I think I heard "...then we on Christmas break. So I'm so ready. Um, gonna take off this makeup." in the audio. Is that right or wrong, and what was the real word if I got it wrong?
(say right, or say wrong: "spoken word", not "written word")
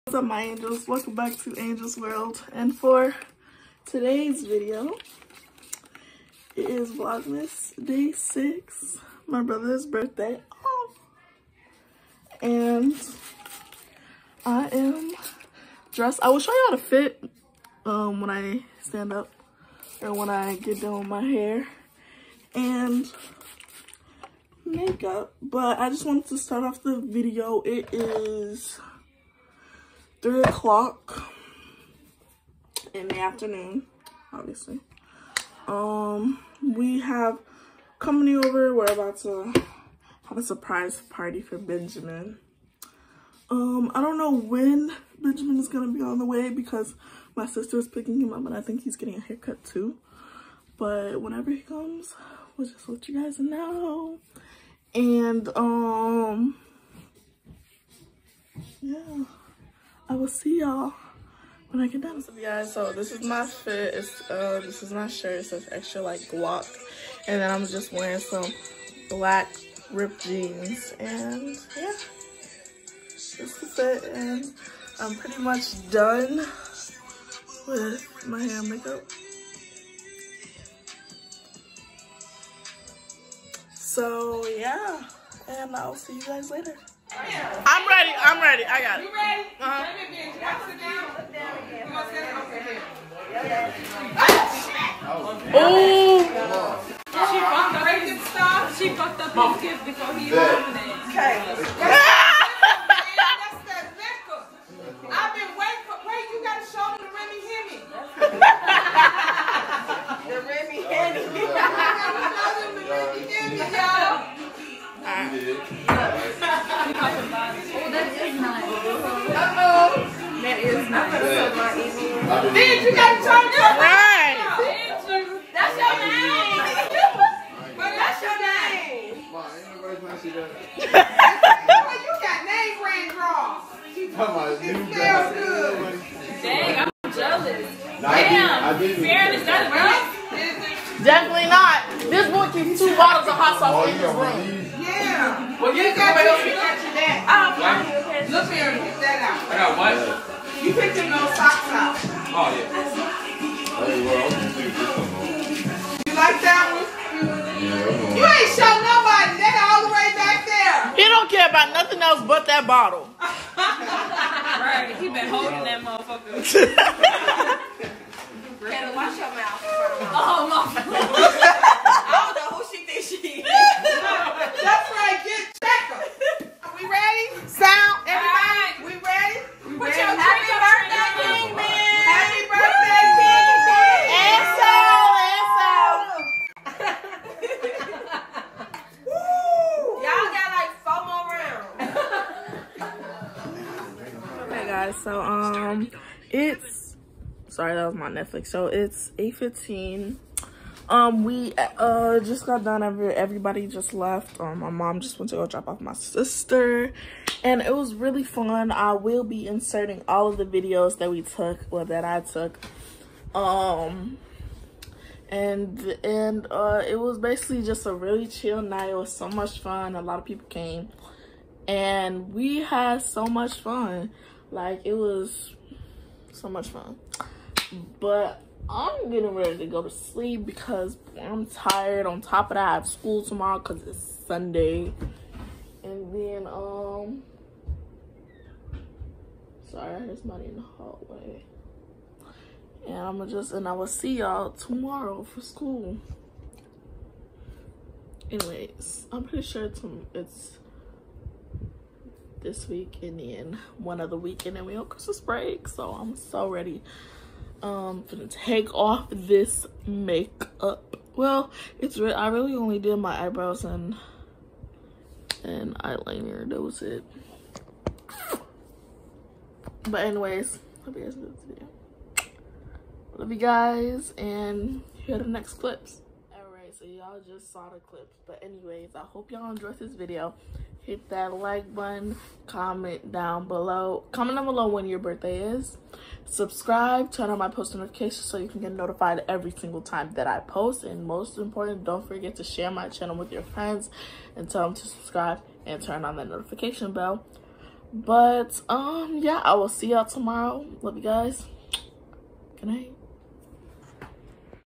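right.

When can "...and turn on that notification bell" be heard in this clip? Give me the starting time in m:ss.
4:55.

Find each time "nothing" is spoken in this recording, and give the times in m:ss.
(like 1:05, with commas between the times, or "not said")
2:41.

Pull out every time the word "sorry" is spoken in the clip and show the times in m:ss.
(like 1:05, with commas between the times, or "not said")
3:17, 3:59.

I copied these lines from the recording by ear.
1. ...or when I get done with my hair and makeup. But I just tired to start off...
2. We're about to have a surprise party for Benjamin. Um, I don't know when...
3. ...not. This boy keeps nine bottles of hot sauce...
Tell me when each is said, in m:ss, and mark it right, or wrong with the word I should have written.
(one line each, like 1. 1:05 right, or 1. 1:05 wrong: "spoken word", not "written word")
1. 0:20 wrong: "wanted", not "tired"
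2. 0:38 right
3. 2:21 wrong: "two", not "nine".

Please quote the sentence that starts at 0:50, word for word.
But whenever he comes, we'll just let you guys know.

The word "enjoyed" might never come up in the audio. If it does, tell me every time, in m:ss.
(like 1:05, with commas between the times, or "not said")
4:31, 4:39.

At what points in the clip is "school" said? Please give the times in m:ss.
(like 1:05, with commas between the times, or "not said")
3:52, 4:05.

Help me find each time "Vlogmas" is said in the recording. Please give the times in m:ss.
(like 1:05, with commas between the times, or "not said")
0:06.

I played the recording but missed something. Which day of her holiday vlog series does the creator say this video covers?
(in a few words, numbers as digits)
6.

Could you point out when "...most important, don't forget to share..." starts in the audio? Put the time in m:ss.
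4:51.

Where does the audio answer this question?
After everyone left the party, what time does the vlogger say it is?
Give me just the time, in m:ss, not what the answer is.
3:19.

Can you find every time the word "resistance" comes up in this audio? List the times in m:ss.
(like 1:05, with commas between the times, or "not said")
not said.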